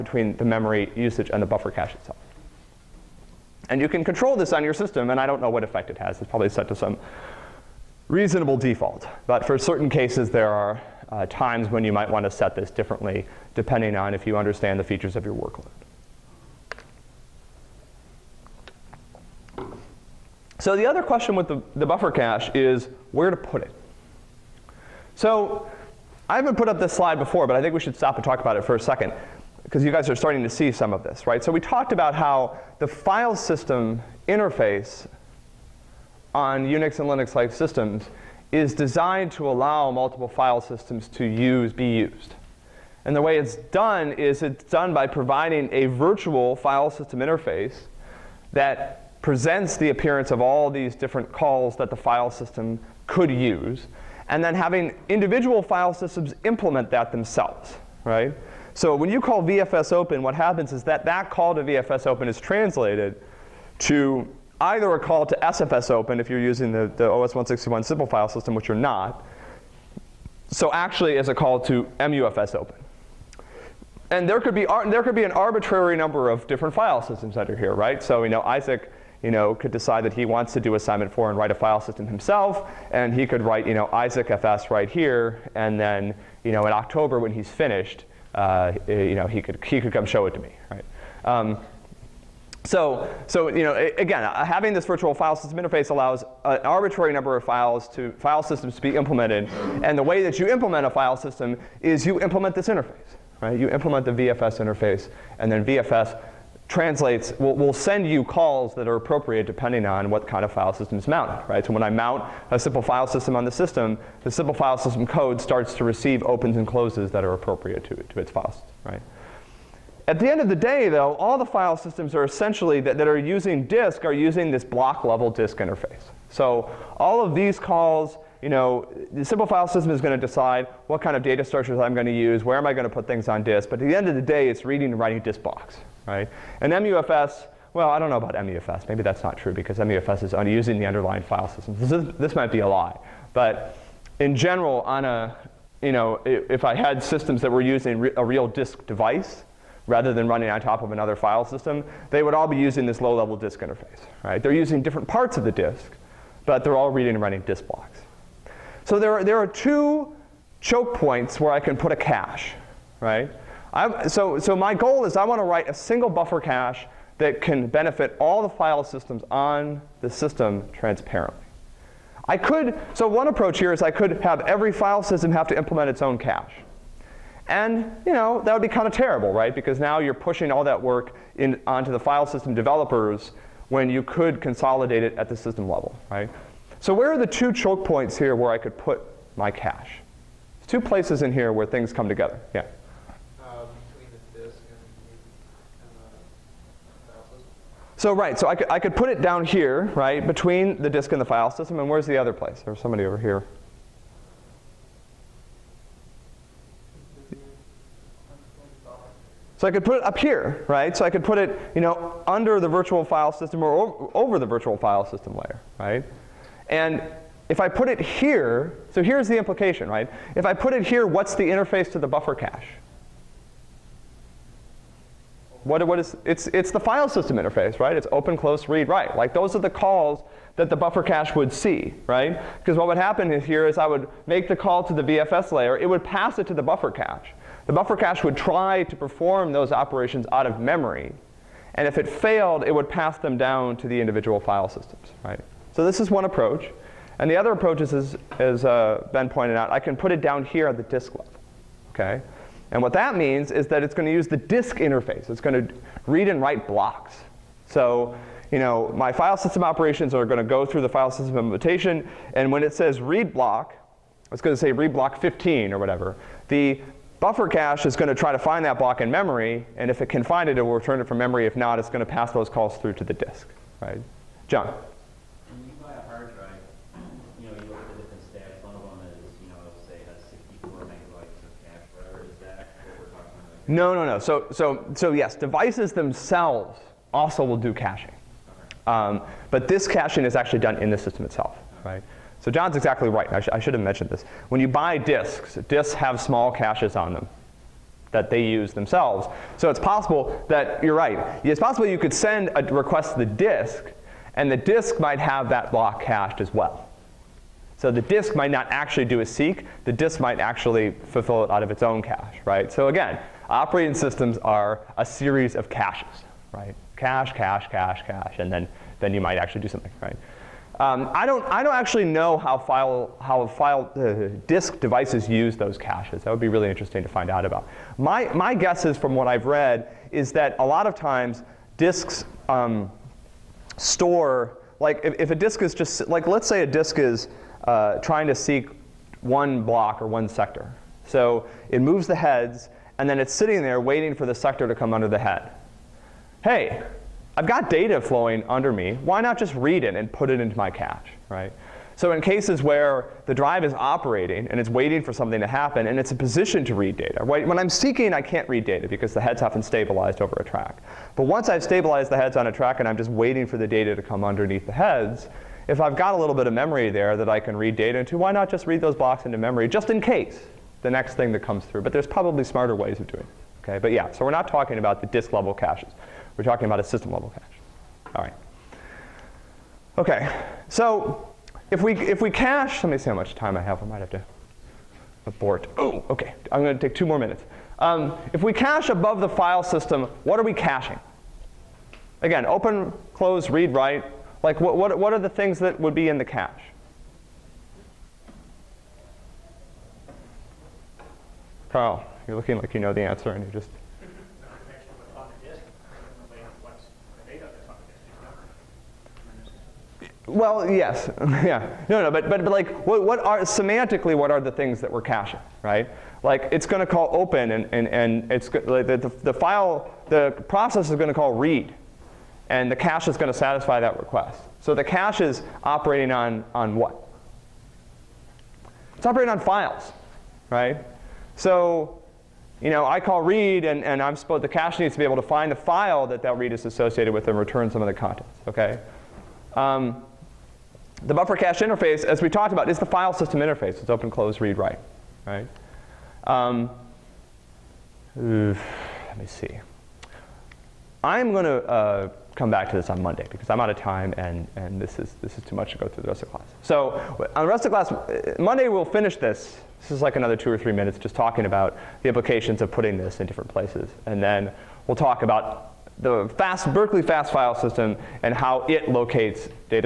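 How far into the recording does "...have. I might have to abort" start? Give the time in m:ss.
6:23.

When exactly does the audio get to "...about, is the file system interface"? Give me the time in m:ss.
7:22.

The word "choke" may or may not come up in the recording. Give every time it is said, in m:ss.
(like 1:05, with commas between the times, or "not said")
2:40, 3:07.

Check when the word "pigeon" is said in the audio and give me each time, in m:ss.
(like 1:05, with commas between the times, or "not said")
not said.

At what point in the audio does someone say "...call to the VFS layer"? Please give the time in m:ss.
3:54.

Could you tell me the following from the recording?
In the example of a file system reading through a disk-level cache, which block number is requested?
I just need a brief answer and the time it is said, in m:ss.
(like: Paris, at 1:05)
15, at 4:24.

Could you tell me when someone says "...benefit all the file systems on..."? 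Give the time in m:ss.
2:47.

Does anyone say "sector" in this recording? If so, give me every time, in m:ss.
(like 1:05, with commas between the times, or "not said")
5:40, 5:44.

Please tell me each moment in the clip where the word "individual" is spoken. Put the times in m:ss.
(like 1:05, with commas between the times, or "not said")
0:55, 4:03.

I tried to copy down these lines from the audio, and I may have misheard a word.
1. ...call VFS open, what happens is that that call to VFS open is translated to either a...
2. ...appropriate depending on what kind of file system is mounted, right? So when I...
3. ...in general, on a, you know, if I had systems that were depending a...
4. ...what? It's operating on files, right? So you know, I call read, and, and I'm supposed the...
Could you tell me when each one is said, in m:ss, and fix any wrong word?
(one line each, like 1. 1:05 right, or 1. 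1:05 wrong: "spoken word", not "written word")
1. 0:59 right
2. 1:48 right
3. 2:24 wrong: "using", not "depending"
4. 7:06 right.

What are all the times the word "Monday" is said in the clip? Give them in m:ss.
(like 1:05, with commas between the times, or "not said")
7:33, 7:38.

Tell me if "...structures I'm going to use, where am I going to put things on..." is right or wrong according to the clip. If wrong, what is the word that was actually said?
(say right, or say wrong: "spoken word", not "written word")
right.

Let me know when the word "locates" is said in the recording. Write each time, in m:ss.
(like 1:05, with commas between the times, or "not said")
7:48.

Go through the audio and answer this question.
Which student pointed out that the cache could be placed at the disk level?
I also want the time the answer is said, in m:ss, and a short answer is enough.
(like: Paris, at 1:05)
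Ben, at 4:09.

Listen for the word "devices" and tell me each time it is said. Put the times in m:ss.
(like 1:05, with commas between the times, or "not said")
2:28, 4:45, 5:24.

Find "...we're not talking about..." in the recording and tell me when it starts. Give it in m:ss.
6:14.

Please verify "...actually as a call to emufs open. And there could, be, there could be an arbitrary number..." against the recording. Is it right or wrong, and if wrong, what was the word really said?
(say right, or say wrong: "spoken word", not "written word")
right.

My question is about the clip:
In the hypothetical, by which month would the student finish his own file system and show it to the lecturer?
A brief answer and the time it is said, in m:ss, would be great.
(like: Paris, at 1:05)
October, at 1:26.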